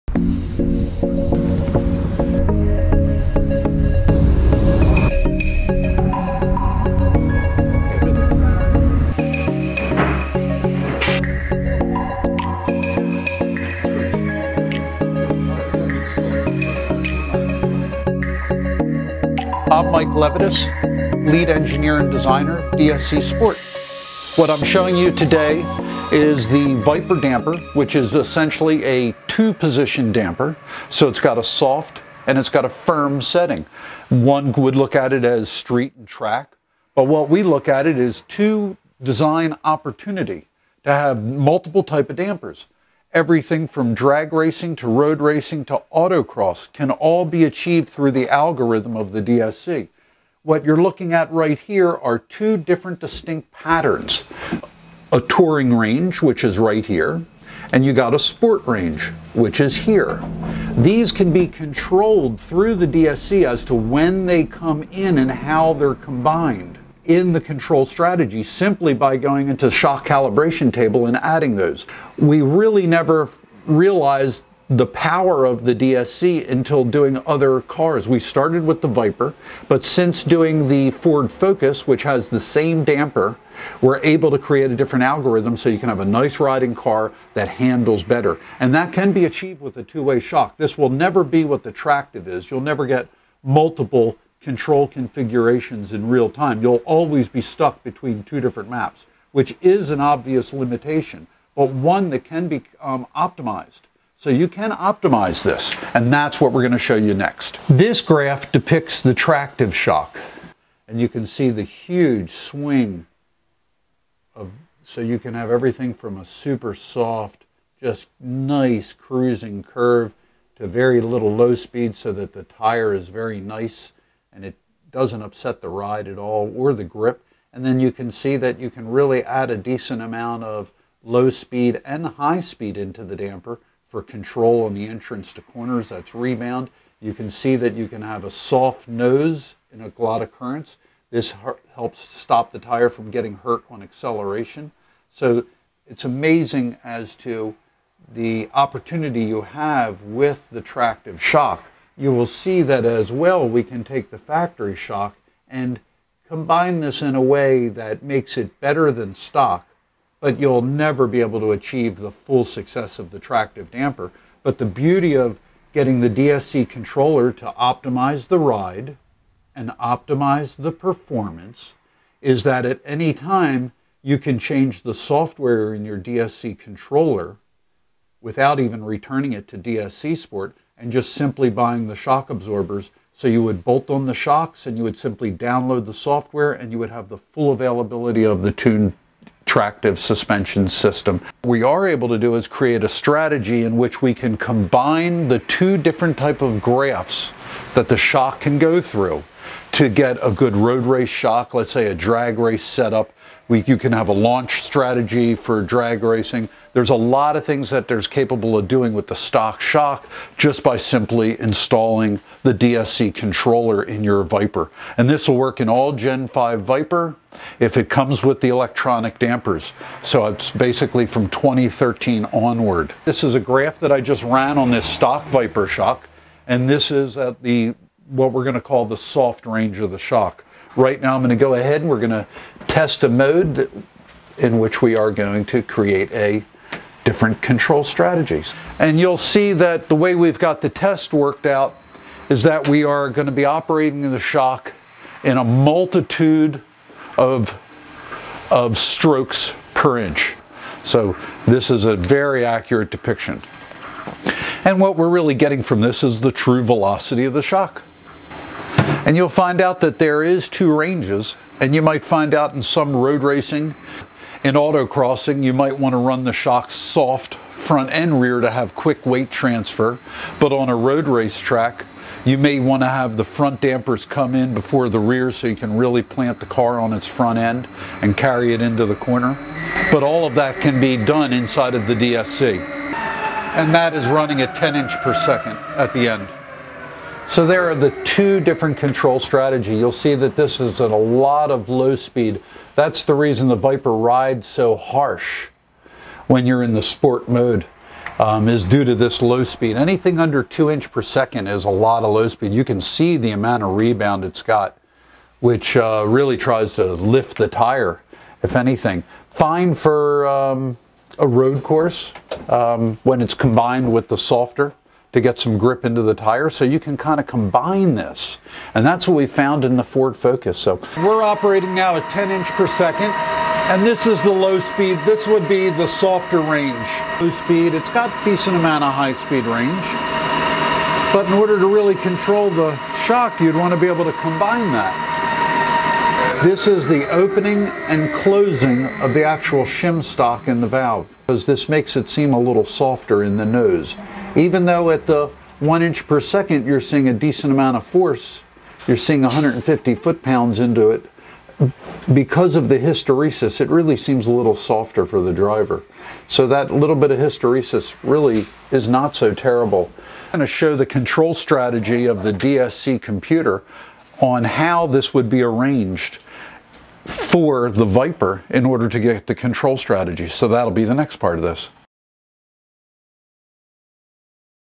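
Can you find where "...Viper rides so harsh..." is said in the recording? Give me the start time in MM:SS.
04:53.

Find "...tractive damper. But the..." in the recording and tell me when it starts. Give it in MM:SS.
02:43.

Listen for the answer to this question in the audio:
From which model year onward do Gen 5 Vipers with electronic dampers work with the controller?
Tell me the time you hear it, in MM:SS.
03:41.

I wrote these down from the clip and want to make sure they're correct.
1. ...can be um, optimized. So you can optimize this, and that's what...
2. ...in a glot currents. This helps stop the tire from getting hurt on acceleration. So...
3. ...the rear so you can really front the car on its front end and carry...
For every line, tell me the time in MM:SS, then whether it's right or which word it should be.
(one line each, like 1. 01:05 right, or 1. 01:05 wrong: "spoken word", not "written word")
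1. 01:42 right
2. 02:19 right
3. 04:34 wrong: "plant", not "front".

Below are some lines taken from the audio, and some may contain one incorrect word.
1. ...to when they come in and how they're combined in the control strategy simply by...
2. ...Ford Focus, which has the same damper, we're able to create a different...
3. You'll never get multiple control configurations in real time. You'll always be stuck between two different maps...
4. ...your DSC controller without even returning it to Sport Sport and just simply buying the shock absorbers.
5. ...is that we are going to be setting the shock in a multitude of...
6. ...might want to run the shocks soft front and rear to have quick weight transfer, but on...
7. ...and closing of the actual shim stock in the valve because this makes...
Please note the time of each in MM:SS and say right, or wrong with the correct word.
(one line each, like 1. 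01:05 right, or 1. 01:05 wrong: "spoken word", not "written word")
1. 01:03 right
2. 01:20 right
3. 01:32 right
4. 02:55 wrong: "DSC", not "Sport"
5. 04:02 wrong: "operating", not "setting"
6. 04:25 right
7. 05:37 right.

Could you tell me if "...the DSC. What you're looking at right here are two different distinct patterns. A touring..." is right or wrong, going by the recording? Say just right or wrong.
right.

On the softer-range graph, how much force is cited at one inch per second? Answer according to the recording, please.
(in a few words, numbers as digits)
150 foot-pounds.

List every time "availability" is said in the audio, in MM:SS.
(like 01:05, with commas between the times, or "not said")
03:07.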